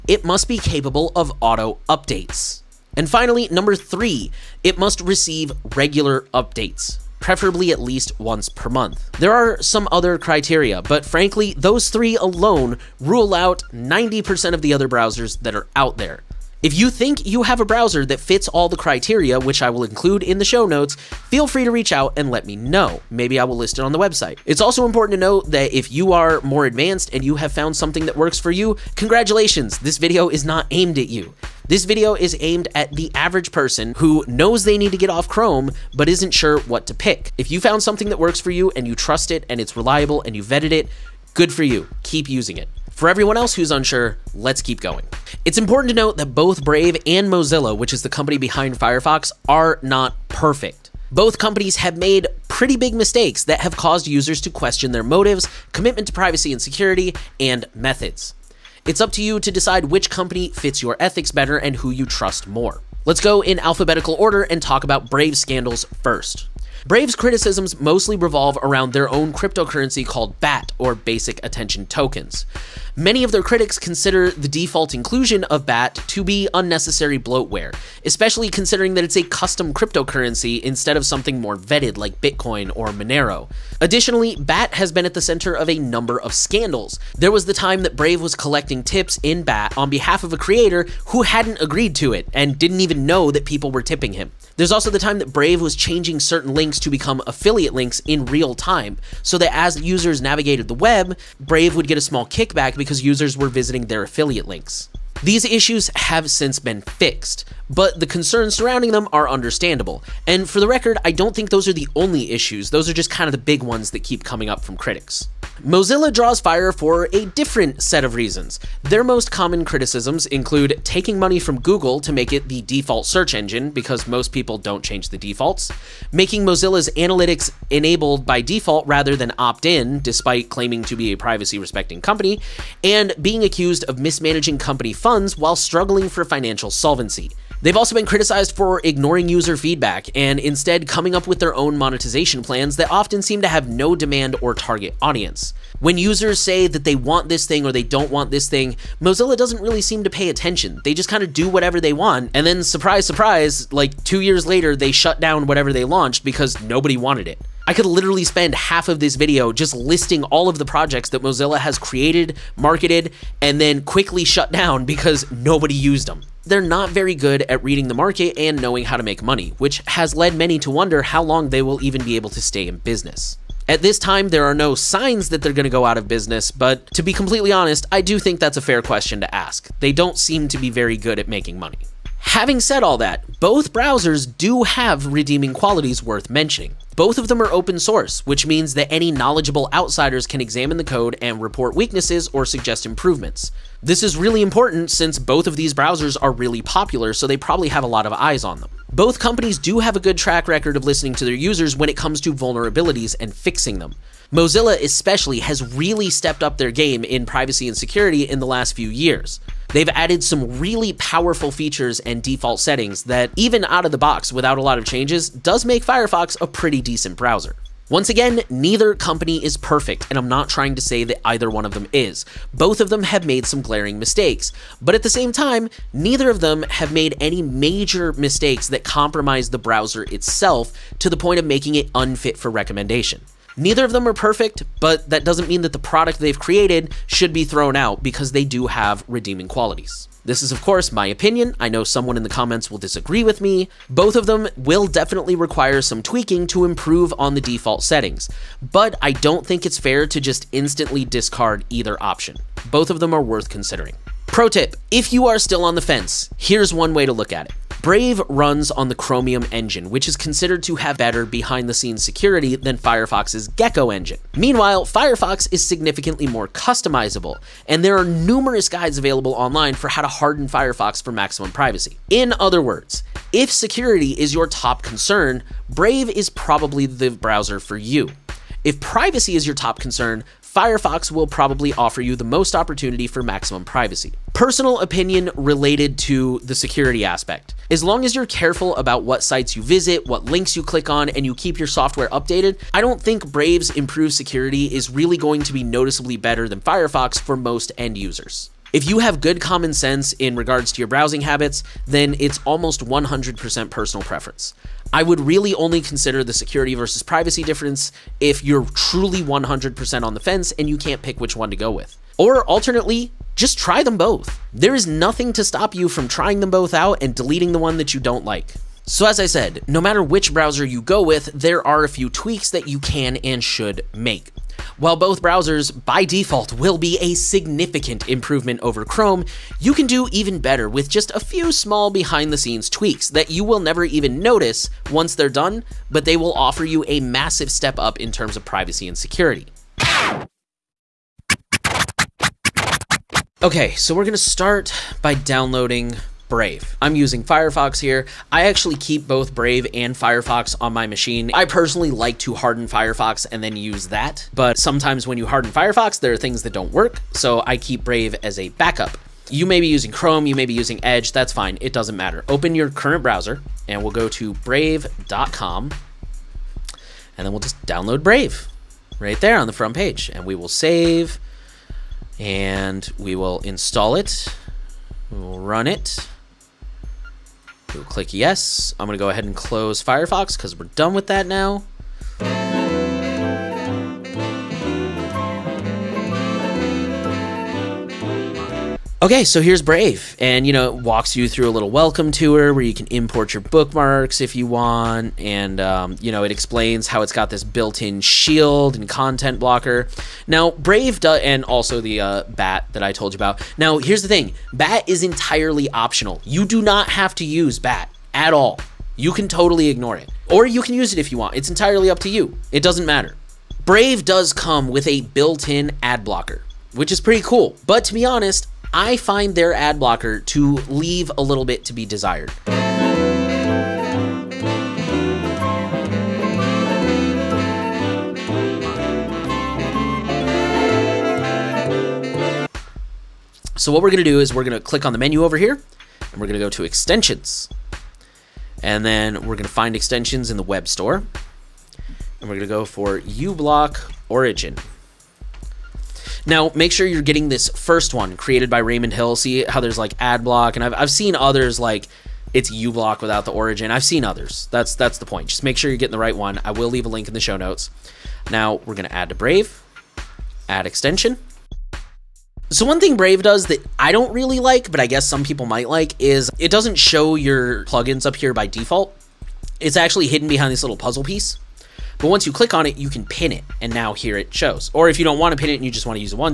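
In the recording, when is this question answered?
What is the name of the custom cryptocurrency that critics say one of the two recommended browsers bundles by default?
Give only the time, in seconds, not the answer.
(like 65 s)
70 s.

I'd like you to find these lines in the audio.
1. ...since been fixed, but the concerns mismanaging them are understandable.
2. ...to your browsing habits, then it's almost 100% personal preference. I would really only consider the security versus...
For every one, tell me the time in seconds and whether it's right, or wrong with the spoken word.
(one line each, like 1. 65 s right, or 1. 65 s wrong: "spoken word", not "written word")
1. 106 s wrong: "surrounding", not "mismanaging"
2. 300 s right.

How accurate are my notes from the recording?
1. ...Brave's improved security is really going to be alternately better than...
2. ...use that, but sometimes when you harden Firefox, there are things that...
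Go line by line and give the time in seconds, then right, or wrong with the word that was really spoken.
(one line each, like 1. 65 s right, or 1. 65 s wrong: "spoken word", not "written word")
1. 293 s wrong: "noticeably", not "alternately"
2. 353 s right.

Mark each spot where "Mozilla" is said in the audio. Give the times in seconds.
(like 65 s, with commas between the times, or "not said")
47 s, 115 s, 126 s, 148 s, 161 s, 204 s.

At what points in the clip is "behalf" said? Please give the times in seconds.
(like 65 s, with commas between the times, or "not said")
89 s.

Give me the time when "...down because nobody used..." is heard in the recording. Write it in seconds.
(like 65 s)
164 s.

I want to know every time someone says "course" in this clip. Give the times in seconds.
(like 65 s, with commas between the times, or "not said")
240 s.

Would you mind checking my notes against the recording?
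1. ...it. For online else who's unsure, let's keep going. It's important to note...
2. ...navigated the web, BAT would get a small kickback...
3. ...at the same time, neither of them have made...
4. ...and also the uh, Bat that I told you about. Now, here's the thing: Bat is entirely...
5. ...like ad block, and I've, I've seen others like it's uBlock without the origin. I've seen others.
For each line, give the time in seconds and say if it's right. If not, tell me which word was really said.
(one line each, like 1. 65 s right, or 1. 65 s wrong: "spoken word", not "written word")
1. 42 s wrong: "everyone", not "online"
2. 100 s wrong: "Brave", not "BAT"
3. 224 s right
4. 401 s right
5. 449 s right.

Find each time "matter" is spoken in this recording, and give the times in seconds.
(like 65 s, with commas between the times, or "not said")
319 s, 361 s, 412 s.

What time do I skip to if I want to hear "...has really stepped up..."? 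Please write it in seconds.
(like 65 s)
205 s.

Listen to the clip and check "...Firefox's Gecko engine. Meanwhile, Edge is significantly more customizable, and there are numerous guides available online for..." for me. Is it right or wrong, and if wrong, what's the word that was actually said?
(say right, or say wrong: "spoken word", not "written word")
wrong: "Firefox", not "Edge".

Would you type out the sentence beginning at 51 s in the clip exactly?
Both companies have made pretty big mistakes that have caused users to question their motives, commitment to privacy and security, and methods.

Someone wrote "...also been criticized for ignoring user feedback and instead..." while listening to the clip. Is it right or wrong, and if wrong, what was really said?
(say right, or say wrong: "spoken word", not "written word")
right.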